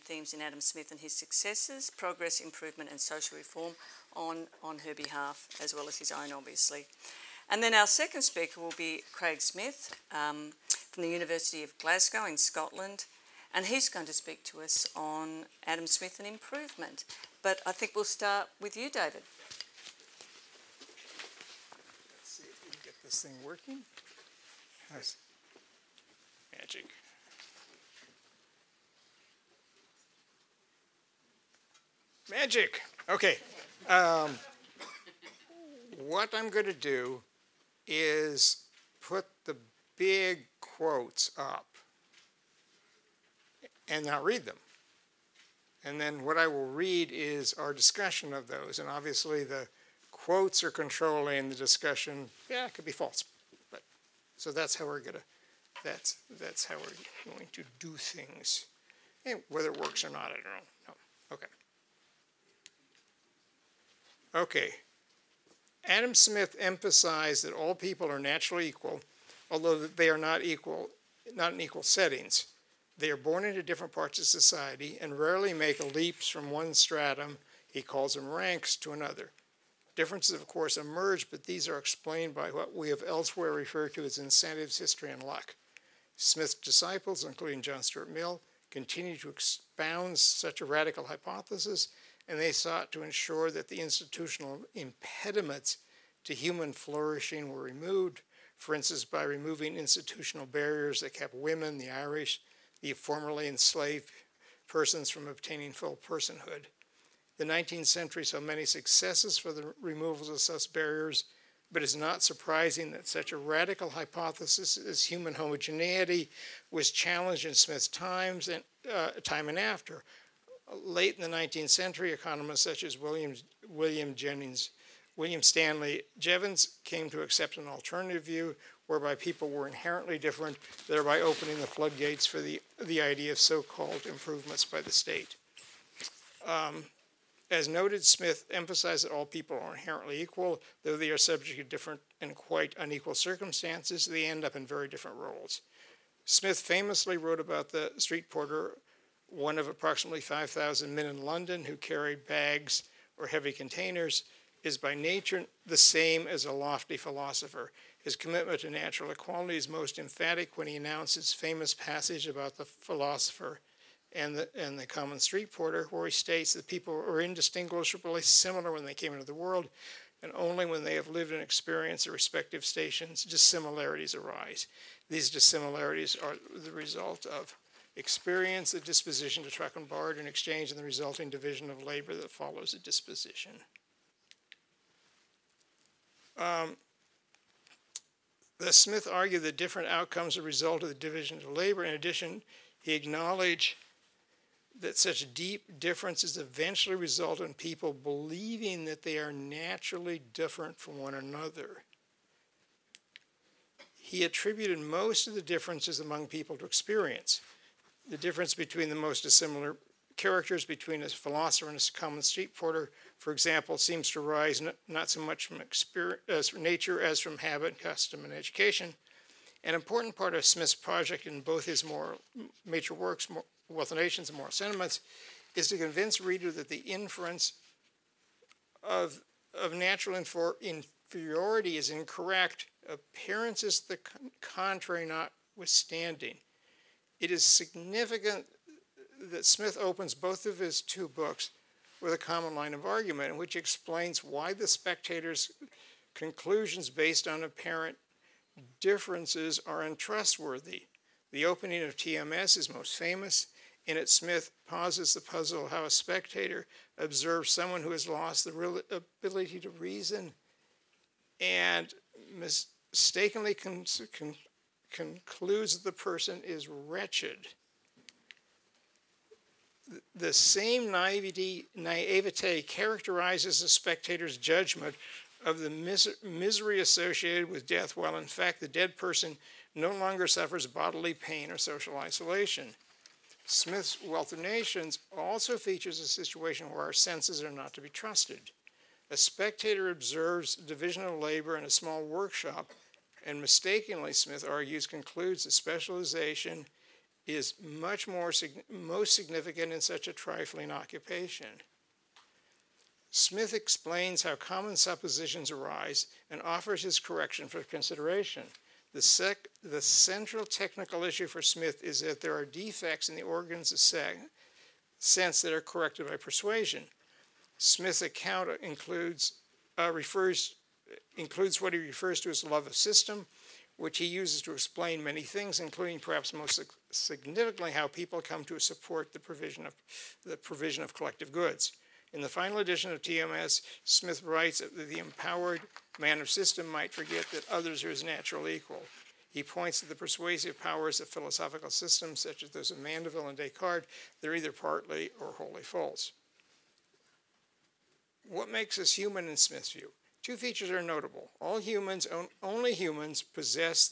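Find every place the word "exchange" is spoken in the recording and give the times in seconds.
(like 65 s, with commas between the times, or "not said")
180 s.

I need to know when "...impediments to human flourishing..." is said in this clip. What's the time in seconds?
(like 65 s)
94 s.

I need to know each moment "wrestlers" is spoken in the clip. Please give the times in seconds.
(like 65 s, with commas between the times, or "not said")
not said.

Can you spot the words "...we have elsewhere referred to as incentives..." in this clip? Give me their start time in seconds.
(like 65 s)
82 s.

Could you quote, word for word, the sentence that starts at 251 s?
The opening of TMS is most famous.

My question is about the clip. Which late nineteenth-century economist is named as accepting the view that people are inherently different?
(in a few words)
William Stanley Jevons.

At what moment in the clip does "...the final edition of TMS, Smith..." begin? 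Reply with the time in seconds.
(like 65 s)
332 s.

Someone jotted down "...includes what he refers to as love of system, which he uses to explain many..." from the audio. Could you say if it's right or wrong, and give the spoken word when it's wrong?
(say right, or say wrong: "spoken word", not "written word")
right.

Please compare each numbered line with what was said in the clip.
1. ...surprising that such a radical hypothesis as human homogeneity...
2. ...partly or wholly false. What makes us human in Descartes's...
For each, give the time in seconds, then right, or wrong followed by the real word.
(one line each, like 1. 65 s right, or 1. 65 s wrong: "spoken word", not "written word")
1. 112 s right
2. 344 s wrong: "Smith", not "Descartes".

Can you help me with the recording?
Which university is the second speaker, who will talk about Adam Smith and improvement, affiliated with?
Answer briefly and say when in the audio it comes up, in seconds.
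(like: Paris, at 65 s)
University of Glasgow, at 11 s.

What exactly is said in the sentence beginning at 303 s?
Smith explains how common suppositions arise and offers his correction for consideration.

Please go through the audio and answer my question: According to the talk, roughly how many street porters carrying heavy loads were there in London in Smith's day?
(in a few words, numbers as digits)
5,000.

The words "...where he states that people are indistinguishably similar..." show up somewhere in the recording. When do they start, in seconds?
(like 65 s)
165 s.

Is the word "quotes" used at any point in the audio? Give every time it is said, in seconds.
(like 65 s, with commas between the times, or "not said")
40 s, 50 s.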